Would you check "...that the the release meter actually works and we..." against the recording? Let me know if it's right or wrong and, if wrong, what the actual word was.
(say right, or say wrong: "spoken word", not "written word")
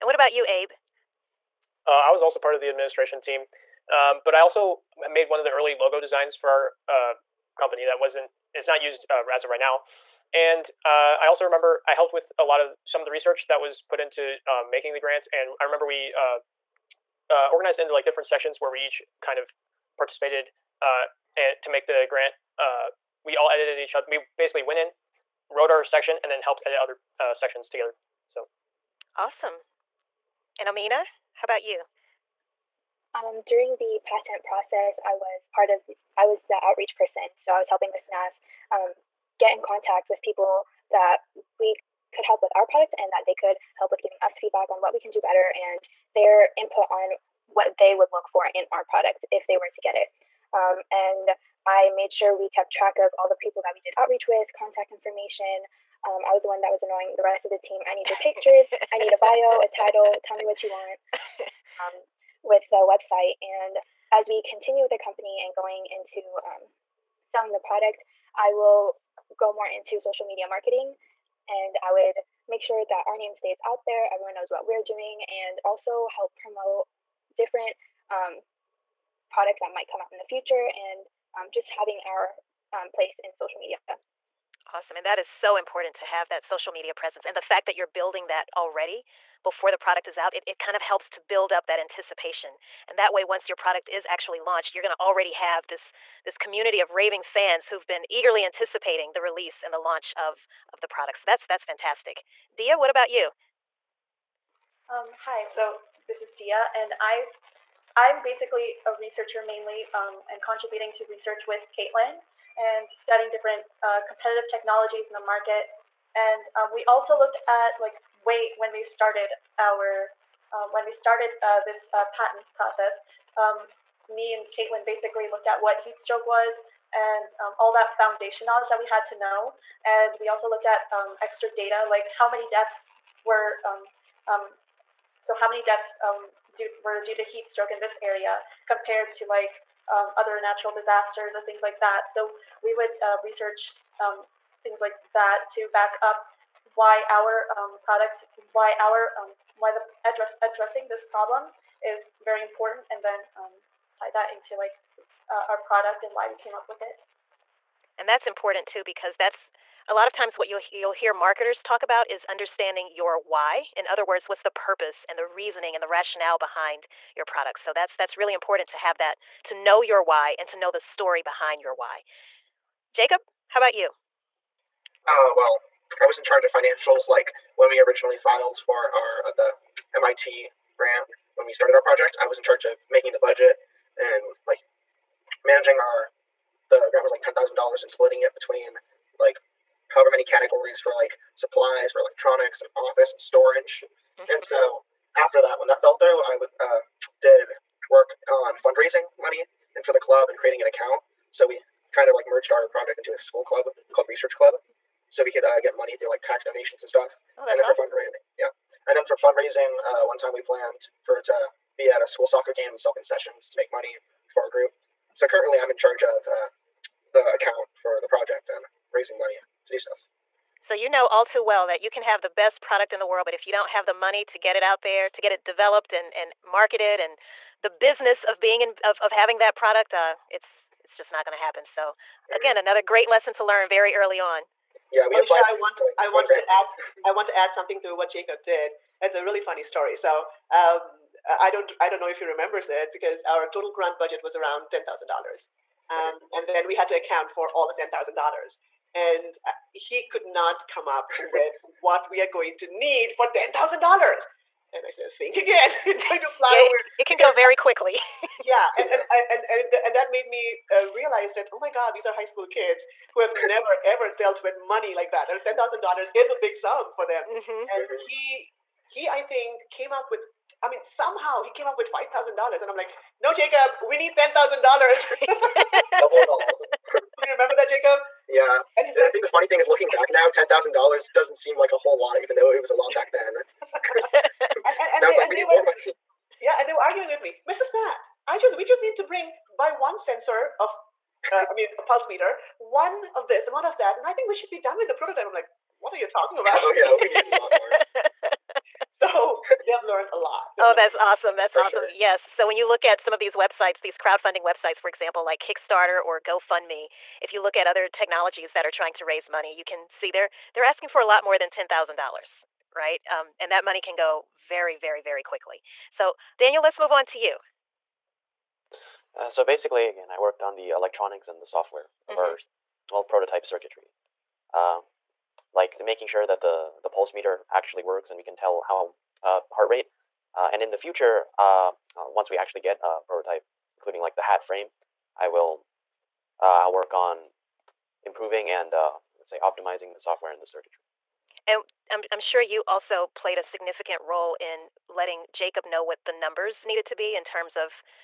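wrong: "pulse", not "release".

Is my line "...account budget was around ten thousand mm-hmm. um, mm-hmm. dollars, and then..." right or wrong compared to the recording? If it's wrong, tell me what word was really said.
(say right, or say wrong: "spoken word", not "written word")
wrong: "grant", not "account".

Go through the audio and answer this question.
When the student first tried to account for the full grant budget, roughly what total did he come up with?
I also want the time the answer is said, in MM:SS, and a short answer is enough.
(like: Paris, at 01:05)
$5,000, at 04:31.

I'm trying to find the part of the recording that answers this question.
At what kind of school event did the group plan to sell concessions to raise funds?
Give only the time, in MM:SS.
03:32.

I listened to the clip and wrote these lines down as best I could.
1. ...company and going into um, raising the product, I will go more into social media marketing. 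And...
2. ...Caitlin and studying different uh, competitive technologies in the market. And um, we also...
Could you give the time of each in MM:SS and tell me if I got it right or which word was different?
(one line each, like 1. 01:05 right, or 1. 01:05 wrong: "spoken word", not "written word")
1. 01:04 wrong: "selling", not "raising"
2. 01:51 right.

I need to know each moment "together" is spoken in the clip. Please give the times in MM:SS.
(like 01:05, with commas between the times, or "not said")
00:27.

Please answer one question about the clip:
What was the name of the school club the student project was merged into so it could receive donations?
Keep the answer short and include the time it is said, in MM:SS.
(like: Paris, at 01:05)
Research Club, at 03:24.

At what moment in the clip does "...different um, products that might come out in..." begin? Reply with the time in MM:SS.
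01:17.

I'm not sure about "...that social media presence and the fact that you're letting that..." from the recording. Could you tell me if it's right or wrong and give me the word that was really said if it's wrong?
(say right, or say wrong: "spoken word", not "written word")
wrong: "building", not "letting".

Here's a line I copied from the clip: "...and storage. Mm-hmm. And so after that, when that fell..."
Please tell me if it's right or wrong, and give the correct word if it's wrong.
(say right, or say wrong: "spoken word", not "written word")
right.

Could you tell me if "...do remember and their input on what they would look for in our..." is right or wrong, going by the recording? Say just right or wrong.
wrong.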